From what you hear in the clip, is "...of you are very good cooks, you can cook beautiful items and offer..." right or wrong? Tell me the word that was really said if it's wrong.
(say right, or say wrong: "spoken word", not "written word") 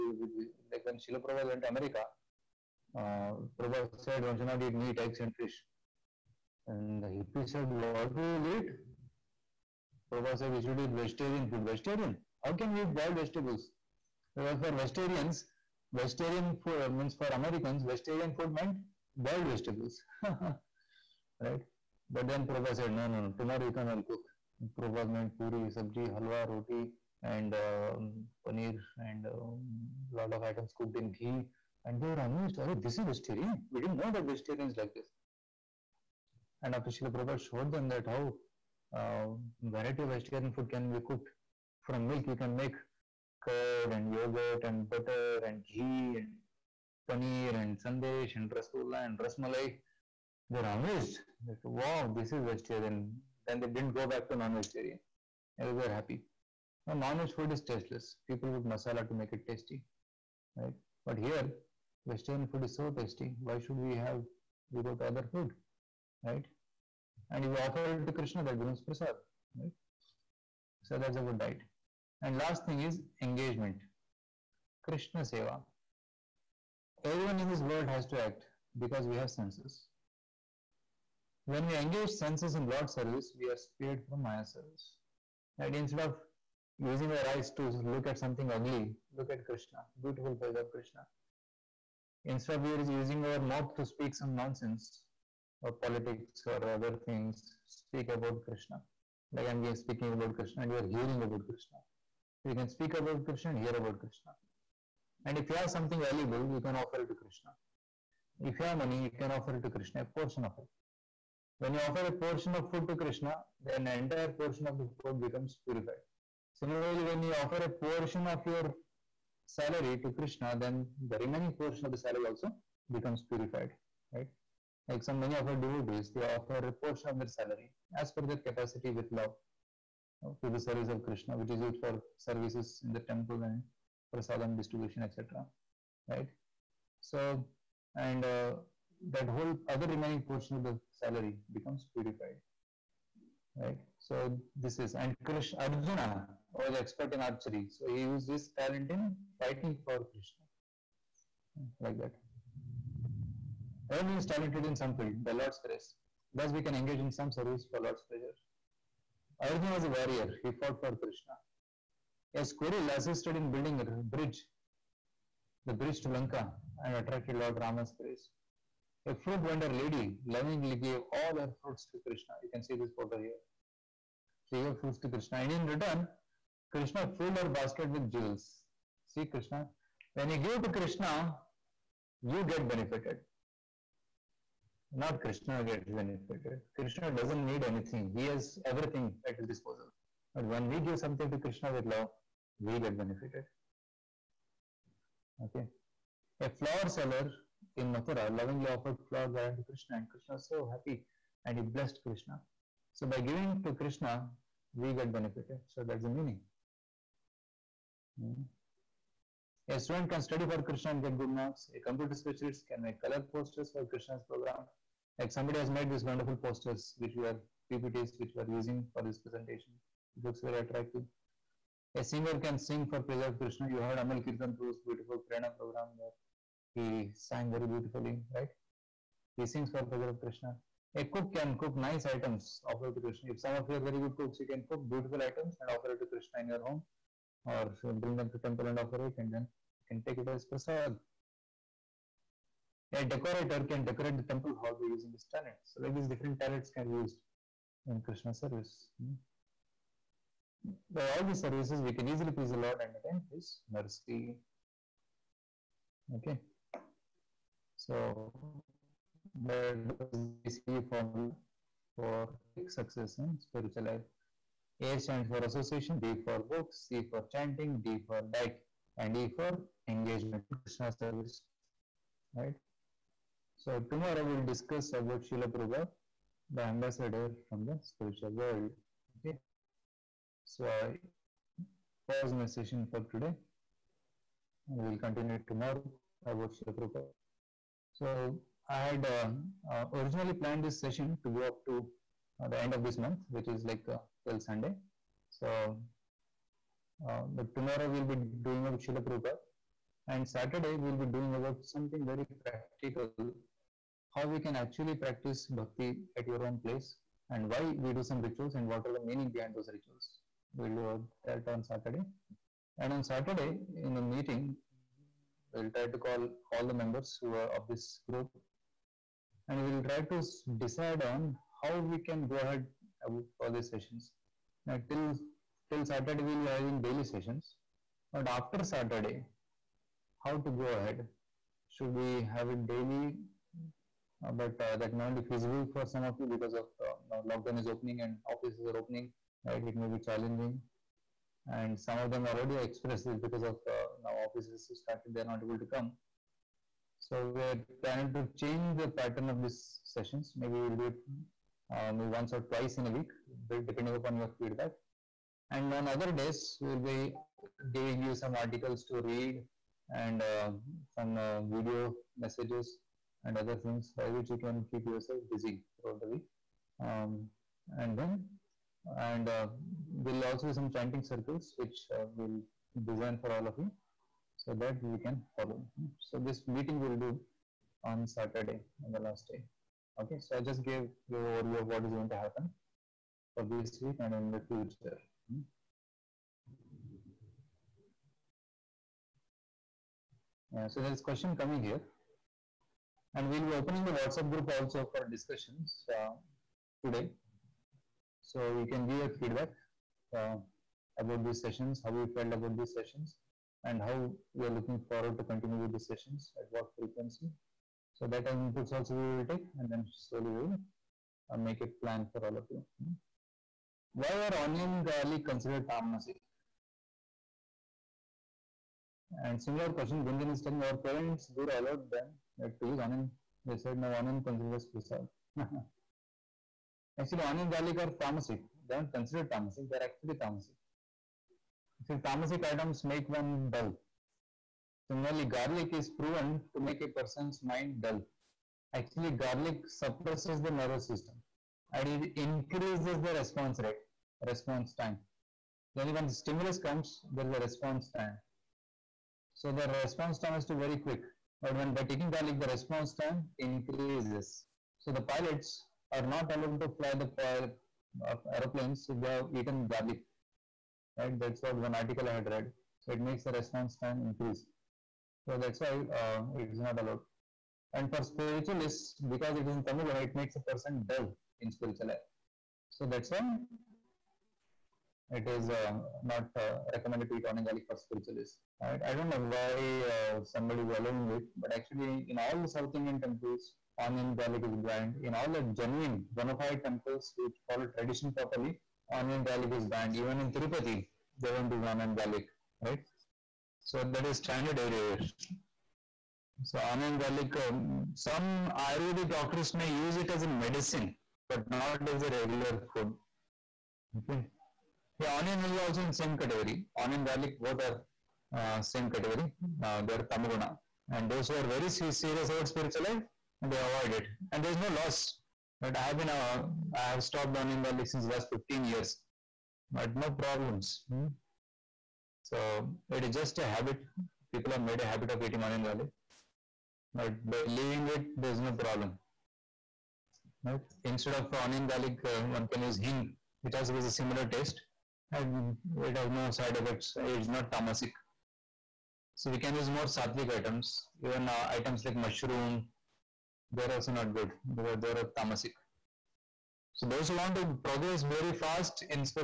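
right.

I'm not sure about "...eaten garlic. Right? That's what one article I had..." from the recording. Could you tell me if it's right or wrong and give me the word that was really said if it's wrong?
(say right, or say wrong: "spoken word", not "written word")
right.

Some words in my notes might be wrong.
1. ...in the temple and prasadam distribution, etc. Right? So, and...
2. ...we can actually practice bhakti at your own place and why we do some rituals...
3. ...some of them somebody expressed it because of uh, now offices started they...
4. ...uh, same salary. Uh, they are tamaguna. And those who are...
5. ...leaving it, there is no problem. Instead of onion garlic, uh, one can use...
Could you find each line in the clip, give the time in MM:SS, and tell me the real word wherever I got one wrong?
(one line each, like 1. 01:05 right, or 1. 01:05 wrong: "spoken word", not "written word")
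1. 02:12 right
2. 05:04 right
3. 05:41 wrong: "already", not "somebody"
4. 08:28 wrong: "category", not "salary"
5. 08:47 right.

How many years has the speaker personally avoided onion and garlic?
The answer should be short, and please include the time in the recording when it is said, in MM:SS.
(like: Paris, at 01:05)
15, at 08:38.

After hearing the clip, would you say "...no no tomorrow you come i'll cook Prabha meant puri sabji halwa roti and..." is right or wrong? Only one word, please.
right.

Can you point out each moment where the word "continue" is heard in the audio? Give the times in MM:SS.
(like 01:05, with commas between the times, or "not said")
04:44, 06:45.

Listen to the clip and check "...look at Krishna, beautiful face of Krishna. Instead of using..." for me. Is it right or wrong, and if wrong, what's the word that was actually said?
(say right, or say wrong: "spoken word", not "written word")
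right.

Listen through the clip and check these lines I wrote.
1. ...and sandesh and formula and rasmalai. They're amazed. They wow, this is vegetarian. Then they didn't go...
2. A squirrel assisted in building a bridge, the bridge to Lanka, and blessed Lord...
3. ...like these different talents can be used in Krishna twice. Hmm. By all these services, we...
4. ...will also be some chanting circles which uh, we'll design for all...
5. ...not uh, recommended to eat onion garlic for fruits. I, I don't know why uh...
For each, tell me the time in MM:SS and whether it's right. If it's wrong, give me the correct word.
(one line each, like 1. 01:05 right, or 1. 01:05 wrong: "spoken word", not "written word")
1. 00:47 wrong: "rasgulla", not "formula"
2. 02:42 wrong: "attracted", not "blessed"
3. 04:05 wrong: "service", not "twice"
4. 06:10 right
5. 07:56 wrong: "spiritualists", not "fruits".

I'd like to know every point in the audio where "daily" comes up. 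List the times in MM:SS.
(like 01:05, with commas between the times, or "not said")
05:26, 05:32.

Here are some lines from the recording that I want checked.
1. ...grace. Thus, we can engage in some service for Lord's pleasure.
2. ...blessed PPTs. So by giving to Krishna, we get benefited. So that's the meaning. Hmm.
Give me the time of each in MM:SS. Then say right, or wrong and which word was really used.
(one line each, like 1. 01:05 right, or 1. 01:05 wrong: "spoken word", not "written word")
1. 02:35 right
2. 03:21 wrong: "Krishna", not "PPTs".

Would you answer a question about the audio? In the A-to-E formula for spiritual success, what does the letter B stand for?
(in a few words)
Books.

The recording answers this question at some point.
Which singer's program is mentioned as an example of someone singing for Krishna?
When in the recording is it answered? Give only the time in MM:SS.
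03:43.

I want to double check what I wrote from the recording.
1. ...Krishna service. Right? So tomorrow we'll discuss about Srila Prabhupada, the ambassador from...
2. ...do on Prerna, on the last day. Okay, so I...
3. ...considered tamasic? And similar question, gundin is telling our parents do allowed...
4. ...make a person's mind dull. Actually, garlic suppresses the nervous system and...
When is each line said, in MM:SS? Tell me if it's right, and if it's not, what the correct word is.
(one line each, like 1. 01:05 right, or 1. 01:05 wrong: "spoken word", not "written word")
1. 04:30 right
2. 06:16 wrong: "Saturday", not "Prerna"
3. 06:55 right
4. 07:16 right.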